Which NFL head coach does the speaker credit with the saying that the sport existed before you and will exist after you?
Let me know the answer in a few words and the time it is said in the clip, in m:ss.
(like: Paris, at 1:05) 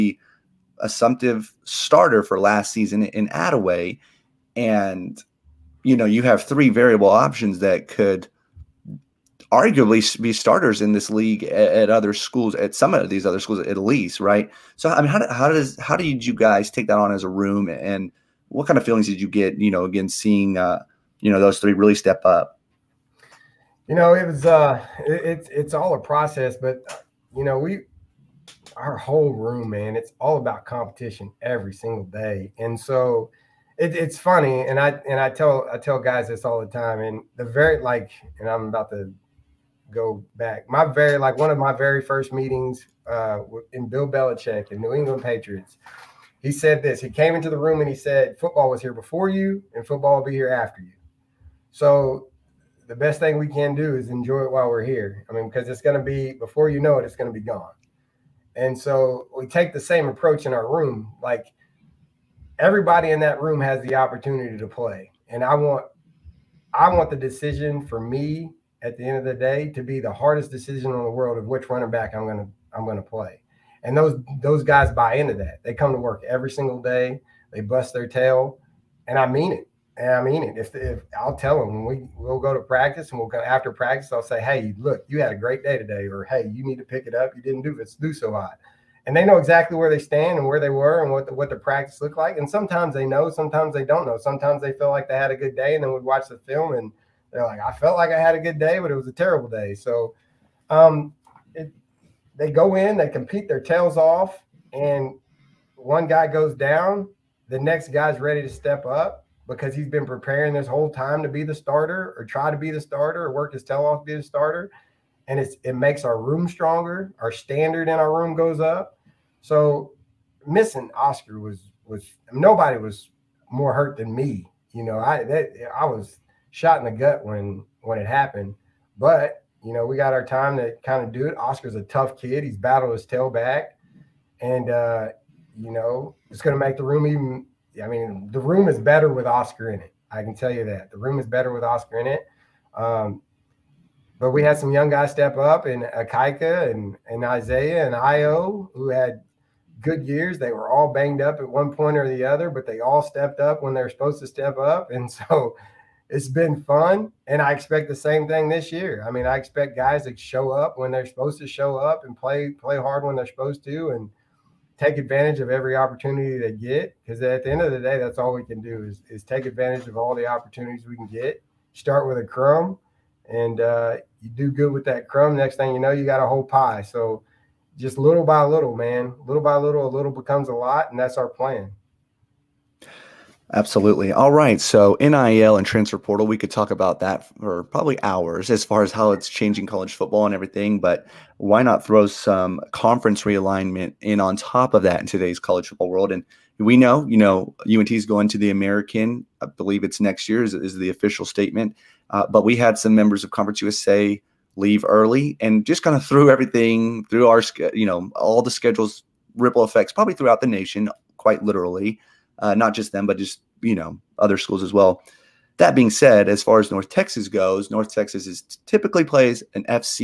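Bill Belichick, at 0:43.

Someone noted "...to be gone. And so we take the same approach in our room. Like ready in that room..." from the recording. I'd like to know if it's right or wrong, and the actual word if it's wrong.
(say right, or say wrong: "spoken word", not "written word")
wrong: "everybody", not "ready".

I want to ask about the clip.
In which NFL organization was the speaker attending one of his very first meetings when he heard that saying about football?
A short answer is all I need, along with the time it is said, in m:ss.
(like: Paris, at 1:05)
New England Patriots, at 0:44.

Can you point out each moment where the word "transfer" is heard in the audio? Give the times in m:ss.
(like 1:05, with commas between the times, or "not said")
3:05.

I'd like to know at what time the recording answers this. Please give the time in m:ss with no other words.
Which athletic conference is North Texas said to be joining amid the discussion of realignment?
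3:18.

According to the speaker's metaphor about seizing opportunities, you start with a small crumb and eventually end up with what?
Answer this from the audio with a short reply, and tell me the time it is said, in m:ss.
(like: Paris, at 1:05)
a whole pie, at 2:56.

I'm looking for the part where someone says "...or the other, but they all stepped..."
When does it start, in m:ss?
2:31.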